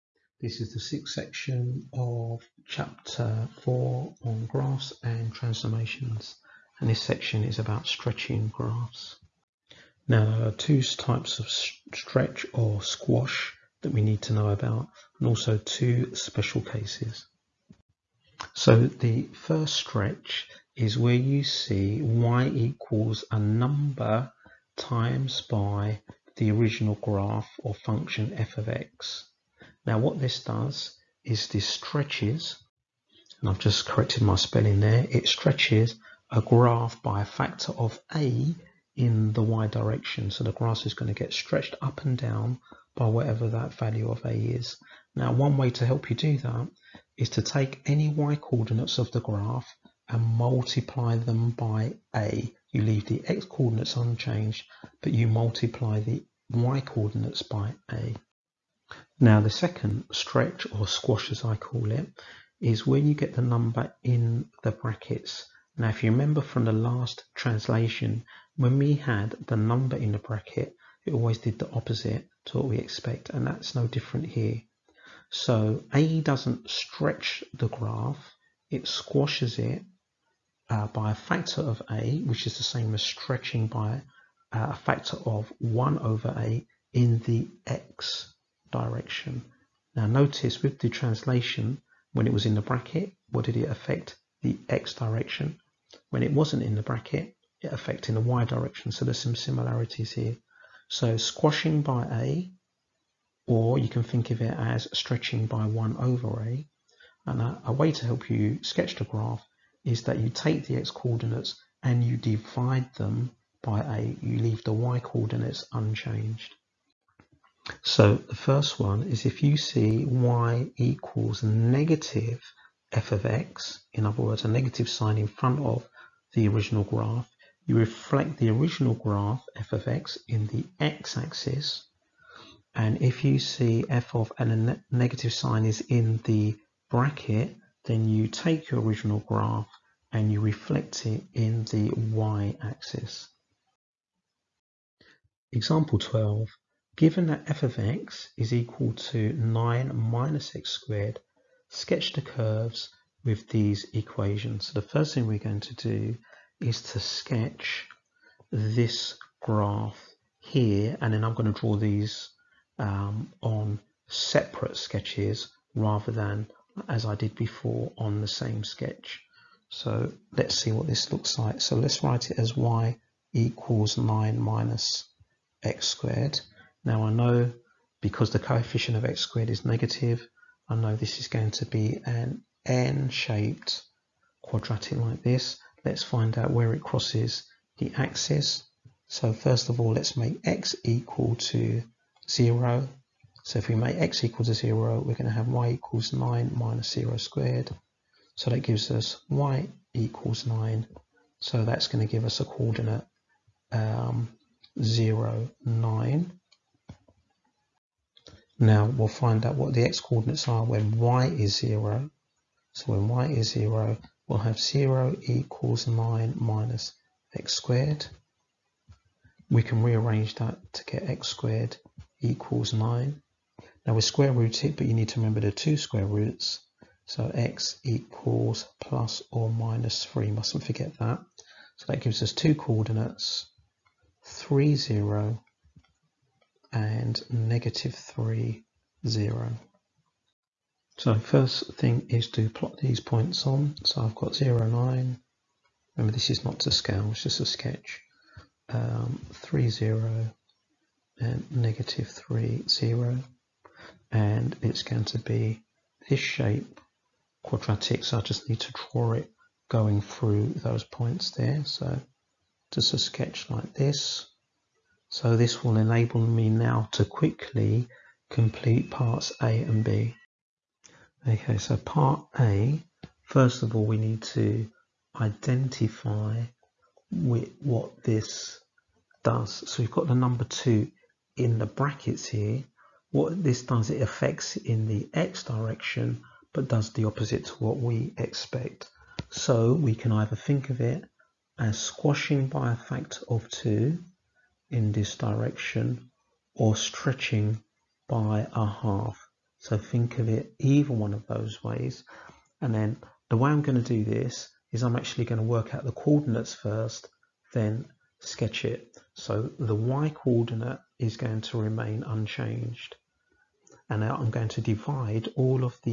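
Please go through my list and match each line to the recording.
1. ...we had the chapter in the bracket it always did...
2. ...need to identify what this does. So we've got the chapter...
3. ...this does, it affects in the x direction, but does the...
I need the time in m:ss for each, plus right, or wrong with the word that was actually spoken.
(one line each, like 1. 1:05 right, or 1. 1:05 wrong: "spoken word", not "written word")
1. 1:08 wrong: "number", not "chapter"
2. 4:33 wrong: "number", not "chapter"
3. 4:43 right.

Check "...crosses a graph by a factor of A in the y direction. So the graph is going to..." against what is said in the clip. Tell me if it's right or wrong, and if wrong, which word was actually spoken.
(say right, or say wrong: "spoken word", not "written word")
wrong: "stretches", not "crosses".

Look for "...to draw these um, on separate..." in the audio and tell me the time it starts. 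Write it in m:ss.
2:41.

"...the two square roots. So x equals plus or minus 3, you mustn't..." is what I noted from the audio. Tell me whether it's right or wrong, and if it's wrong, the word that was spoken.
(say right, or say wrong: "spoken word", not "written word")
right.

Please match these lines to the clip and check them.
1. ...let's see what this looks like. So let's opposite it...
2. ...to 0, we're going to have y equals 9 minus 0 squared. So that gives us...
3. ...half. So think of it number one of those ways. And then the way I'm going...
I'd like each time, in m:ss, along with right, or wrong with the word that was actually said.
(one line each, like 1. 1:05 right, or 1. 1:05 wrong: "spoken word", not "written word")
1. 2:50 wrong: "write", not "opposite"
2. 3:14 right
3. 4:58 wrong: "either", not "number".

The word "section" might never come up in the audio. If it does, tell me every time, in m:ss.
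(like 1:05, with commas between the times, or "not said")
0:01, 0:07.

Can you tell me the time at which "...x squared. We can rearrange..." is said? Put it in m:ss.
3:37.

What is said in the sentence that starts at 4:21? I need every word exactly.
So just a sketch like this so this will enable me now to quickly complete parts A and B.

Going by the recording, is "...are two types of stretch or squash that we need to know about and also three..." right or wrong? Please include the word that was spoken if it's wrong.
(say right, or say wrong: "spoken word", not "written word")
wrong: "two", not "three".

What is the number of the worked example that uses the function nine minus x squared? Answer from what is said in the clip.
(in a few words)
12.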